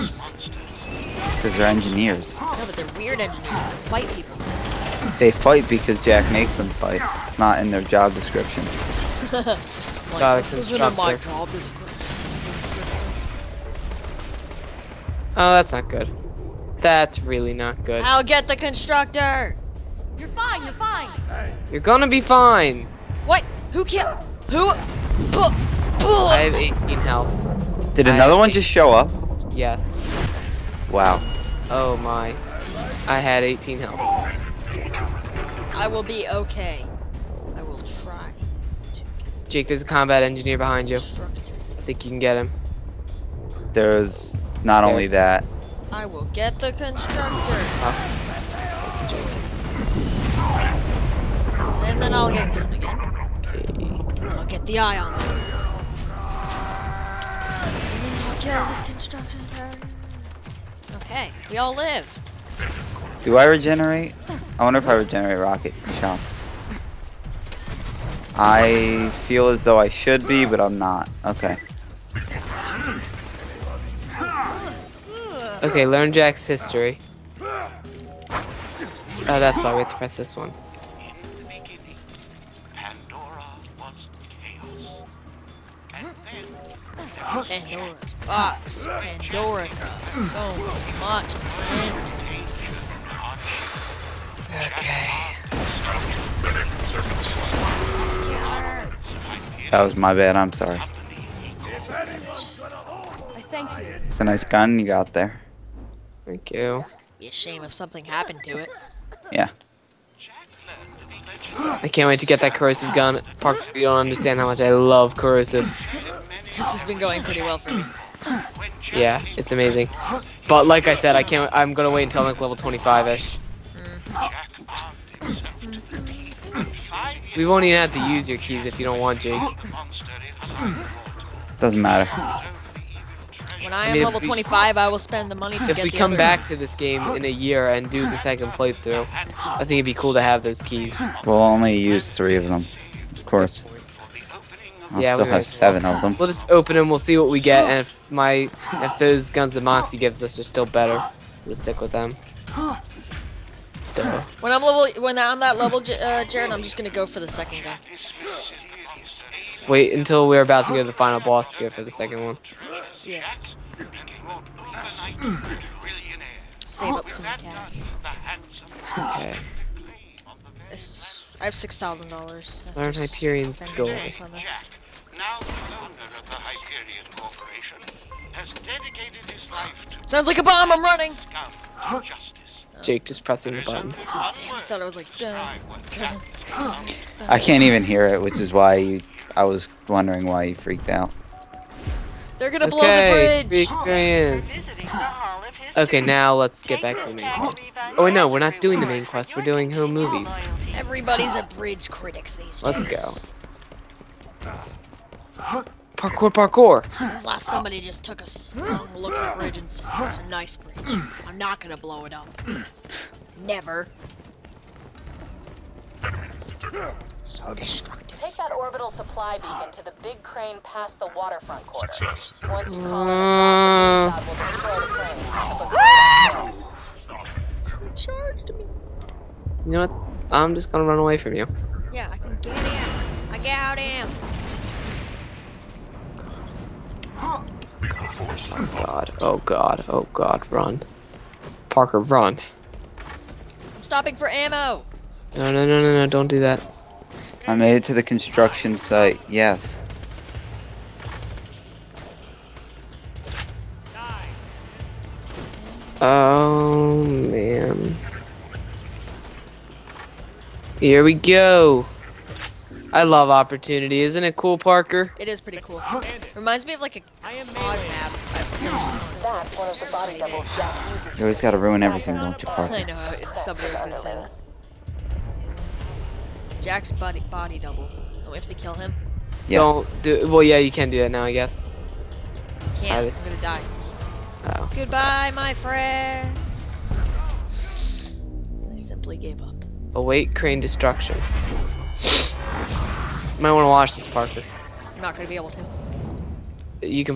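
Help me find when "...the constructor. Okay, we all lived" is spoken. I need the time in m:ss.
0:58.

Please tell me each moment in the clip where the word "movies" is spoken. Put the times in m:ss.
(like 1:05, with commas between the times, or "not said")
3:19.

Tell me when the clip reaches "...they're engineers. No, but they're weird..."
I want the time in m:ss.
0:01.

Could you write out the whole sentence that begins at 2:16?
back to this game in a year and do the second playthrough, I think it'd be cool to have those keys.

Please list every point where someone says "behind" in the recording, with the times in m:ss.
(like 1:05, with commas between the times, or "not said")
0:40.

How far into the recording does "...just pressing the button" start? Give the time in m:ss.
3:03.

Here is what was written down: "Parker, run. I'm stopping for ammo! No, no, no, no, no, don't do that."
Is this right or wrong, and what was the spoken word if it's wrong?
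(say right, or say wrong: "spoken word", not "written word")
right.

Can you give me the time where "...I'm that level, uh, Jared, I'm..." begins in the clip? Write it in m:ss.
2:35.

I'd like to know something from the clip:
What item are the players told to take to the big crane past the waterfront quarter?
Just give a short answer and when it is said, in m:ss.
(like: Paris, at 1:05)
orbital supply beacon, at 3:38.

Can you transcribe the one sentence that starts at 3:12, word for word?
They're gonna blow okay, the bridge.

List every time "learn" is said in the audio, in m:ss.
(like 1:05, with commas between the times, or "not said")
1:15, 2:52.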